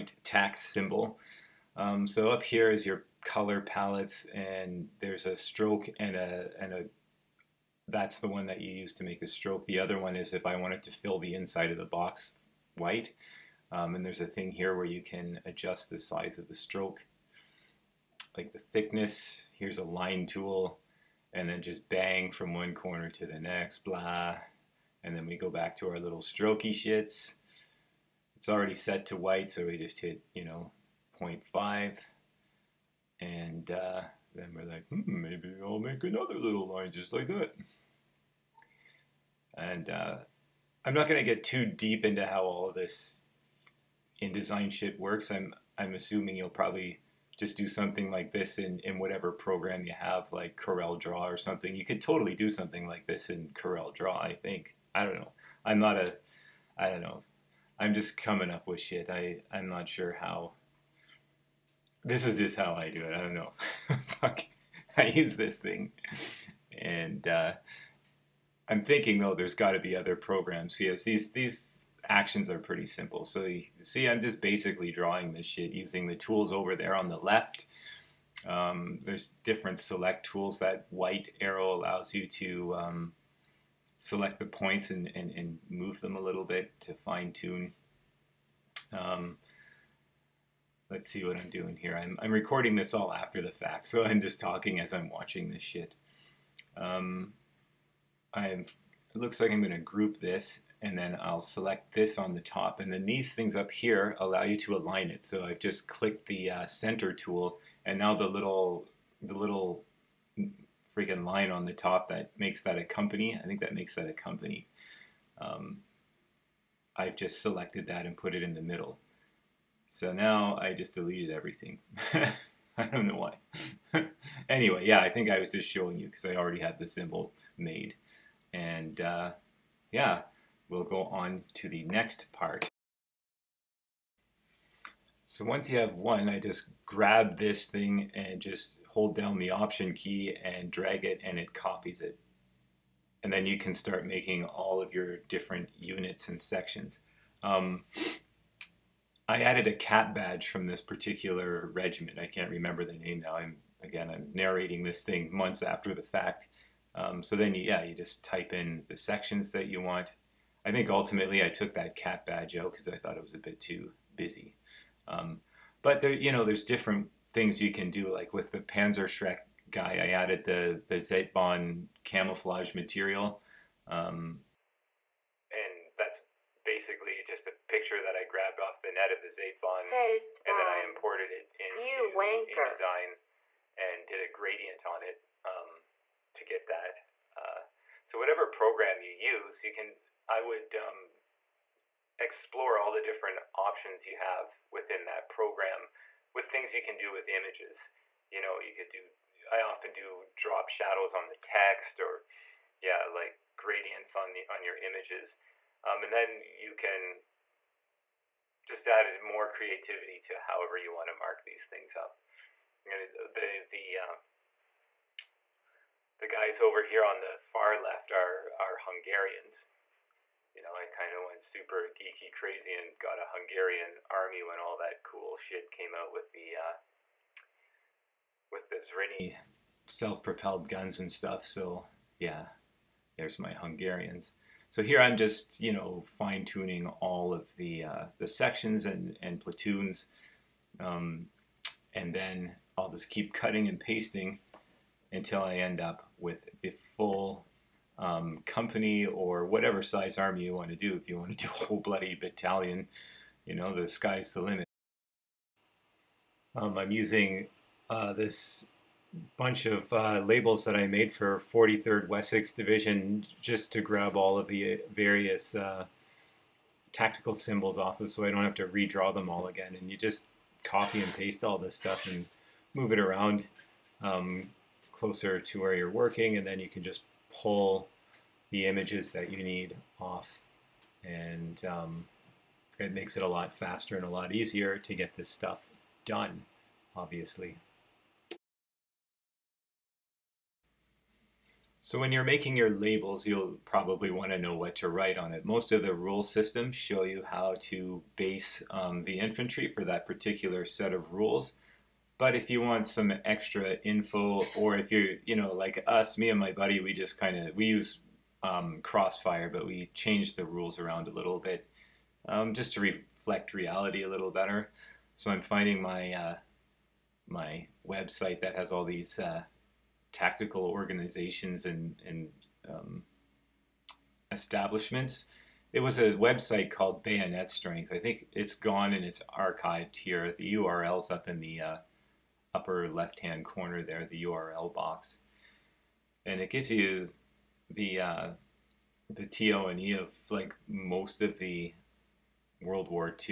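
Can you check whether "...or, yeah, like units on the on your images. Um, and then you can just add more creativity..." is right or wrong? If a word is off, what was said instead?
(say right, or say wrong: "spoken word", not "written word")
wrong: "gradients", not "units".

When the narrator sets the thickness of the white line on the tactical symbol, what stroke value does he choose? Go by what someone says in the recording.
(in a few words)
0.5.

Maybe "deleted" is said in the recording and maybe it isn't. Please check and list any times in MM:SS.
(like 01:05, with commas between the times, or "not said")
02:00.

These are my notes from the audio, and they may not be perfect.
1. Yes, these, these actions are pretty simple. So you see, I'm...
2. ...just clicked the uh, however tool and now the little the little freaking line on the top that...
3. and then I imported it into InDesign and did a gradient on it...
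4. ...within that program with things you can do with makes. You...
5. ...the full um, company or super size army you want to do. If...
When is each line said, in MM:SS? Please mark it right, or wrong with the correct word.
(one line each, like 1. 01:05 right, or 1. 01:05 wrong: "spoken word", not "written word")
1. 01:10 right
2. 01:45 wrong: "center", not "however"
3. 03:00 right
4. 03:14 wrong: "images", not "makes"
5. 04:06 wrong: "whatever", not "super".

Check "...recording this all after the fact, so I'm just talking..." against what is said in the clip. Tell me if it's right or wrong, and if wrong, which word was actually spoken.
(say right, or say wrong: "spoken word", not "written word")
right.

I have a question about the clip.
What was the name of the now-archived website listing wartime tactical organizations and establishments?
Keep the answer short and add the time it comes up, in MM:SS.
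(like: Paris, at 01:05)
Bayonet Strength, at 05:27.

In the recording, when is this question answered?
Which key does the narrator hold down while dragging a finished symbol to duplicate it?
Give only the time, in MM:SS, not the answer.
02:19.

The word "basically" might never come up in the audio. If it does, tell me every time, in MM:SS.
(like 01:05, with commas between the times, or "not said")
01:14, 02:56.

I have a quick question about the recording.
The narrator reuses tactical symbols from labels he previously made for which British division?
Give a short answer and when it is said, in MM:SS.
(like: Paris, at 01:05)
43rd Wessex Division, at 04:21.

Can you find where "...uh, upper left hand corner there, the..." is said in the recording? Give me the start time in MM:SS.
05:31.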